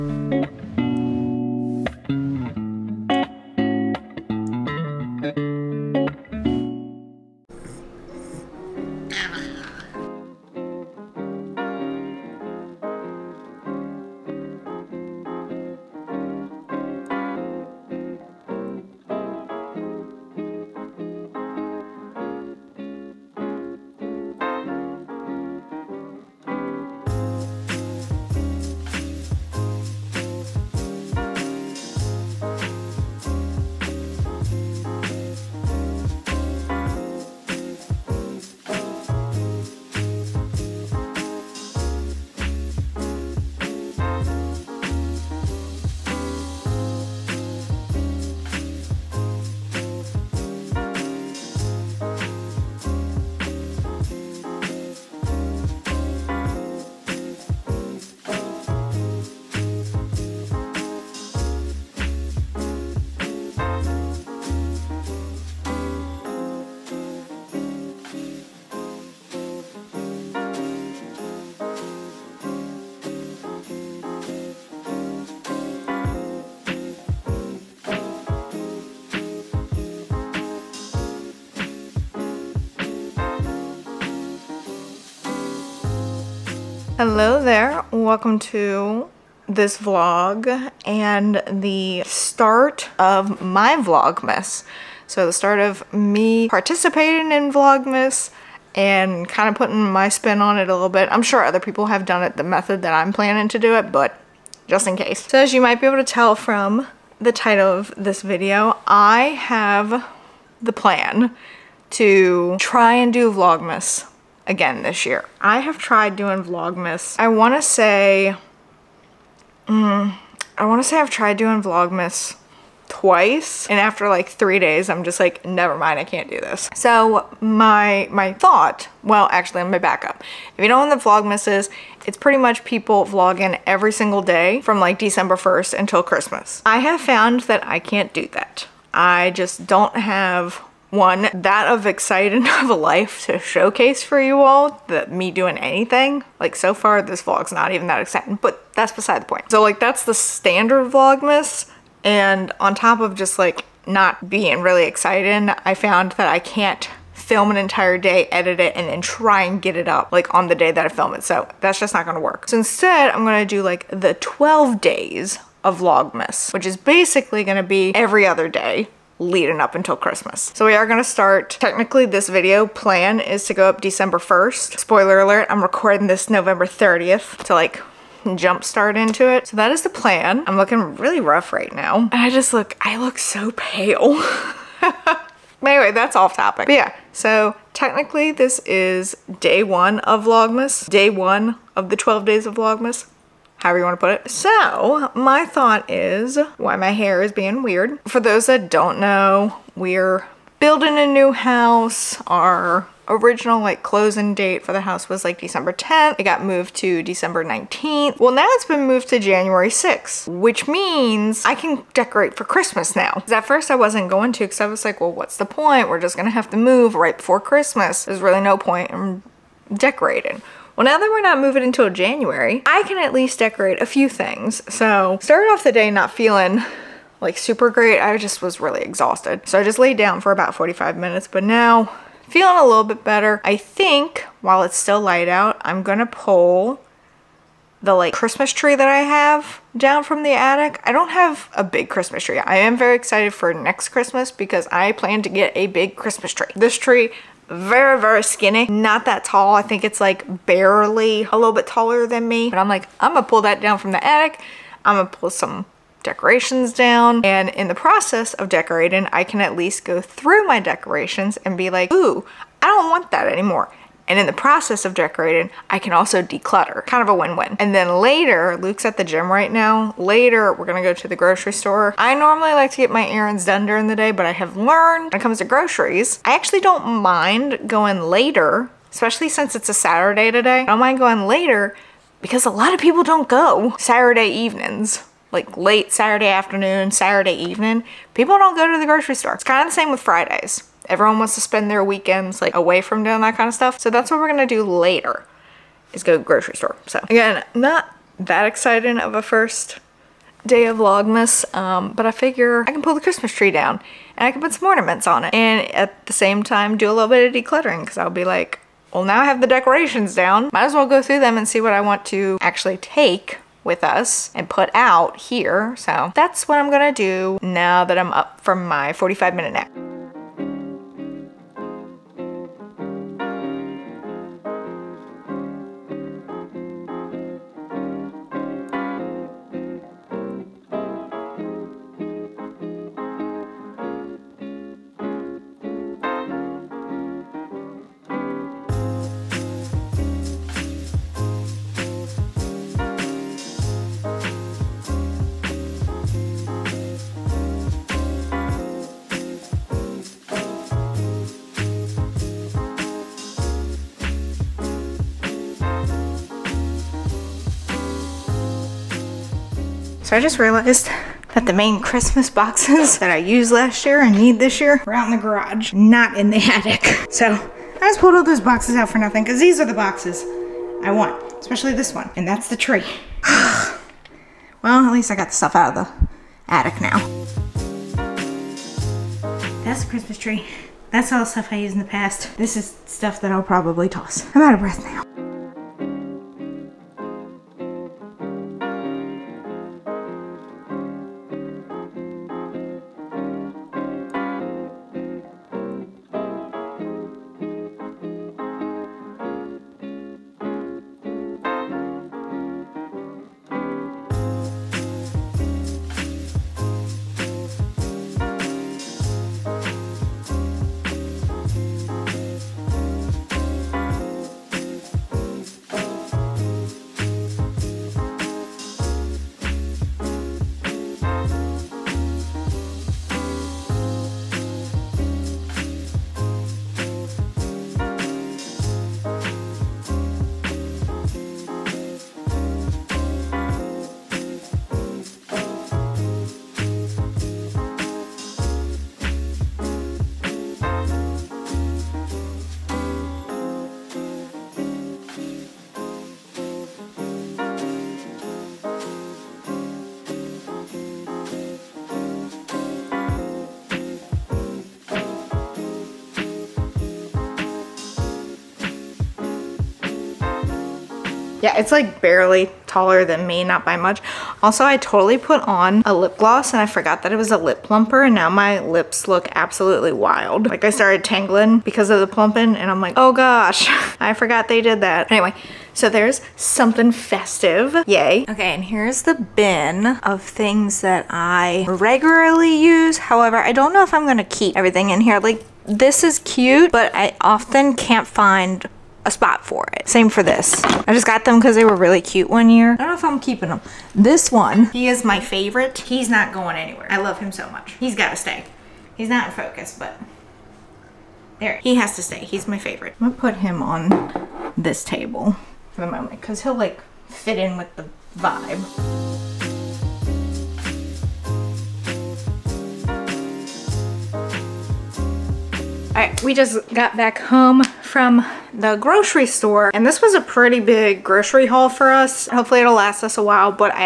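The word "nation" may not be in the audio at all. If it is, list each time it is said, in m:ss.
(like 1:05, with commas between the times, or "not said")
not said.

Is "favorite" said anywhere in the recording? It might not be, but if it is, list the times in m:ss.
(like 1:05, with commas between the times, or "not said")
8:15, 8:22.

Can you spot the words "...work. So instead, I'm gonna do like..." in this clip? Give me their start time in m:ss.
2:42.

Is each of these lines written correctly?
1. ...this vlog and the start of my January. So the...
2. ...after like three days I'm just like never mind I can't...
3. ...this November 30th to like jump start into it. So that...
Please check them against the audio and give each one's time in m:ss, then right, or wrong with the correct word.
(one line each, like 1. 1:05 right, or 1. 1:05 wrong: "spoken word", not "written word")
1. 1:29 wrong: "Vlogmas", not "January"
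2. 2:03 right
3. 2:56 right.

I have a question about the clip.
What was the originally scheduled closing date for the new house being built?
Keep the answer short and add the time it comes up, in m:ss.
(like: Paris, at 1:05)
December 10th, at 3:25.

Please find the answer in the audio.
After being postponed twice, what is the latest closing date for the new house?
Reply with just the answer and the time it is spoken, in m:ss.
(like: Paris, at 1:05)
January 6th, at 3:29.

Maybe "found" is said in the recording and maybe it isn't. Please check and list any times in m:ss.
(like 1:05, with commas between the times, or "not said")
2:17, 2:35.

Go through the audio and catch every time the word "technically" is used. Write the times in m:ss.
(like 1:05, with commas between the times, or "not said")
2:51, 3:07.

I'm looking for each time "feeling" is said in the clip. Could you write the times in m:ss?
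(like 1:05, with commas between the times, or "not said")
3:46, 3:52.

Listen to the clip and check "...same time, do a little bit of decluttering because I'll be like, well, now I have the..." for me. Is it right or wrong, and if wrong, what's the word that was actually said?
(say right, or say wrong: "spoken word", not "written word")
right.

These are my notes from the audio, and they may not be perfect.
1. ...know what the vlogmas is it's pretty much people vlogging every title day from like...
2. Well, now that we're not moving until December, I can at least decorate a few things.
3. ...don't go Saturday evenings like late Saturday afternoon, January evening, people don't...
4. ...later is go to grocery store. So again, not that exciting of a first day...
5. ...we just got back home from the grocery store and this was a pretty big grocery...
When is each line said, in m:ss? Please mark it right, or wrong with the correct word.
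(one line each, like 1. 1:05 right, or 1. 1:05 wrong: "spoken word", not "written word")
1. 2:10 wrong: "single", not "title"
2. 3:40 wrong: "January", not "December"
3. 4:43 wrong: "Saturday", not "January"
4. 4:54 right
5. 8:36 right.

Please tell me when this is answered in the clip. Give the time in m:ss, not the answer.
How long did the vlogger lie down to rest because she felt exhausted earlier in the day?
3:50.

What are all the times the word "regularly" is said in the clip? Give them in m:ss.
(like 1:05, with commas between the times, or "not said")
8:01.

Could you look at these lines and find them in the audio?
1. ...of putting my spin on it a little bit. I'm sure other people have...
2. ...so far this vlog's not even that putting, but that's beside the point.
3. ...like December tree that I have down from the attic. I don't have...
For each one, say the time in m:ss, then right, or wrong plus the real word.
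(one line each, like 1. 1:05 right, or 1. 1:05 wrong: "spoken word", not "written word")
1. 1:39 right
2. 2:26 wrong: "exciting", not "putting"
3. 3:57 wrong: "Christmas", not "December".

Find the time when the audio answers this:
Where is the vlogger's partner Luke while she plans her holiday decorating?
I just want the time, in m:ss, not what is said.
4:28.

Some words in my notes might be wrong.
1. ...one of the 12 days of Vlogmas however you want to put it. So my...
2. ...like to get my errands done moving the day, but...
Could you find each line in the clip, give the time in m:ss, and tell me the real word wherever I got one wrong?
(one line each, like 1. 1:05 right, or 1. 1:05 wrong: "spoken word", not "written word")
1. 3:11 right
2. 4:32 wrong: "during", not "moving".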